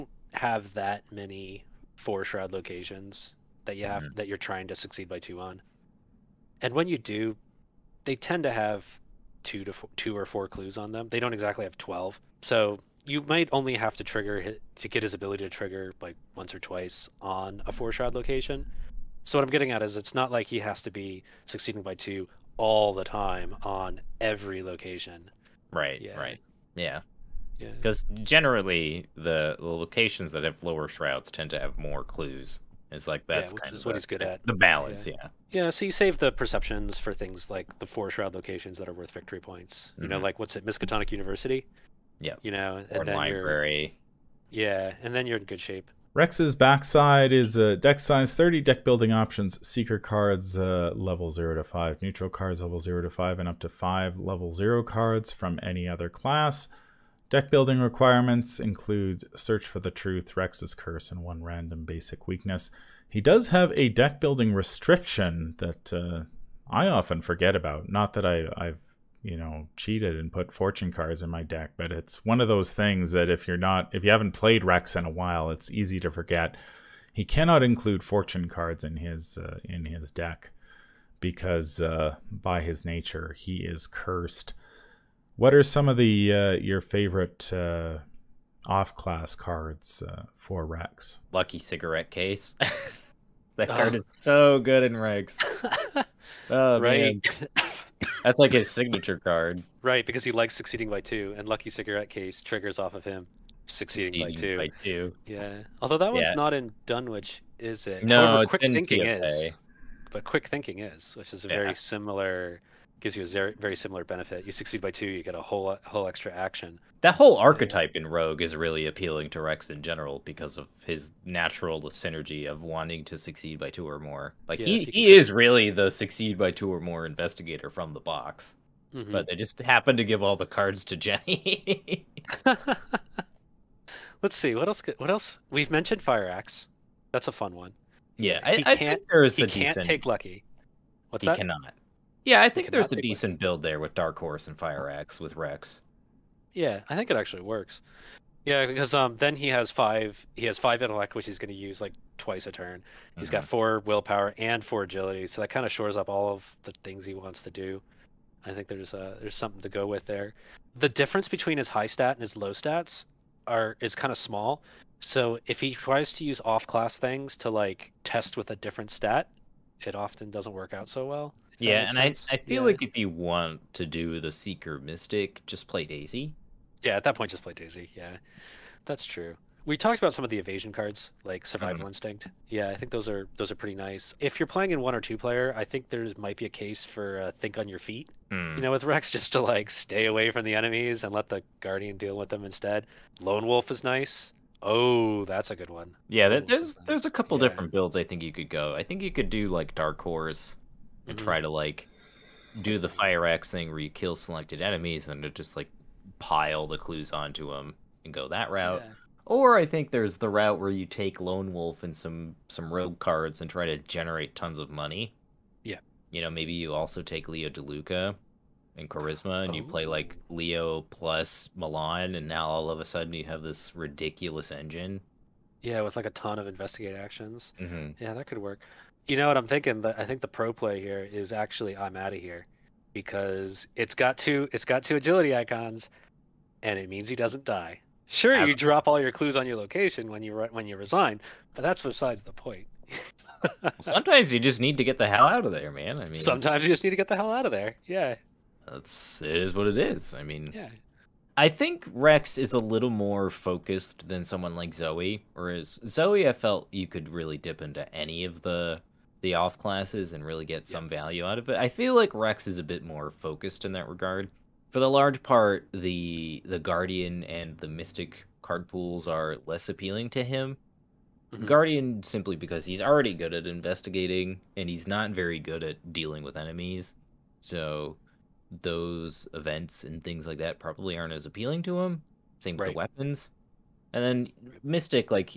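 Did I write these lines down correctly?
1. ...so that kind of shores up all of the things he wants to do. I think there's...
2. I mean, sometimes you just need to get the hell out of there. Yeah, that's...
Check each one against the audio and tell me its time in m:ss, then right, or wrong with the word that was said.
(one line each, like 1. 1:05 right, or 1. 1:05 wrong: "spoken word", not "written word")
1. 2:35 right
2. 4:05 right.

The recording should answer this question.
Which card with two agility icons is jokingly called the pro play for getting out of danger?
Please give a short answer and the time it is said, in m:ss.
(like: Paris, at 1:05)
I'm Out of Here, at 3:51.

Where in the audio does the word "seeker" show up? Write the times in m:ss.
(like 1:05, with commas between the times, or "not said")
0:49, 2:54.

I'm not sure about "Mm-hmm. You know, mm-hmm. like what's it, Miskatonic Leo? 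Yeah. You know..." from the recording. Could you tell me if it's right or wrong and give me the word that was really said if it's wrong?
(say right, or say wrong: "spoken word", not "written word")
wrong: "University", not "Leo".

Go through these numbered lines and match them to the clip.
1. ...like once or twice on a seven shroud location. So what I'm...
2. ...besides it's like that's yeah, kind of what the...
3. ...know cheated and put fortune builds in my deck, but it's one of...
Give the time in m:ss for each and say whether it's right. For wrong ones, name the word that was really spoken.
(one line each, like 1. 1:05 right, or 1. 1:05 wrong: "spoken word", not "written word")
1. 0:16 wrong: "four", not "seven"
2. 0:32 wrong: "clues", not "besides"
3. 1:09 wrong: "cards", not "builds".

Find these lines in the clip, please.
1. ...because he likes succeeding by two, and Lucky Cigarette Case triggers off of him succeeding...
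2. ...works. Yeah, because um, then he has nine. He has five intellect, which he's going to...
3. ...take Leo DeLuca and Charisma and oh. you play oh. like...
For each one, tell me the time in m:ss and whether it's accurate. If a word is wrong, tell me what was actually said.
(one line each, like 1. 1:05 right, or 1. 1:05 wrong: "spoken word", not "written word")
1. 1:40 right
2. 2:27 wrong: "five", not "nine"
3. 3:37 right.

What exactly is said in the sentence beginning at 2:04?
Like yeah, he, he, he is really the succeed by two or more investigator from the box.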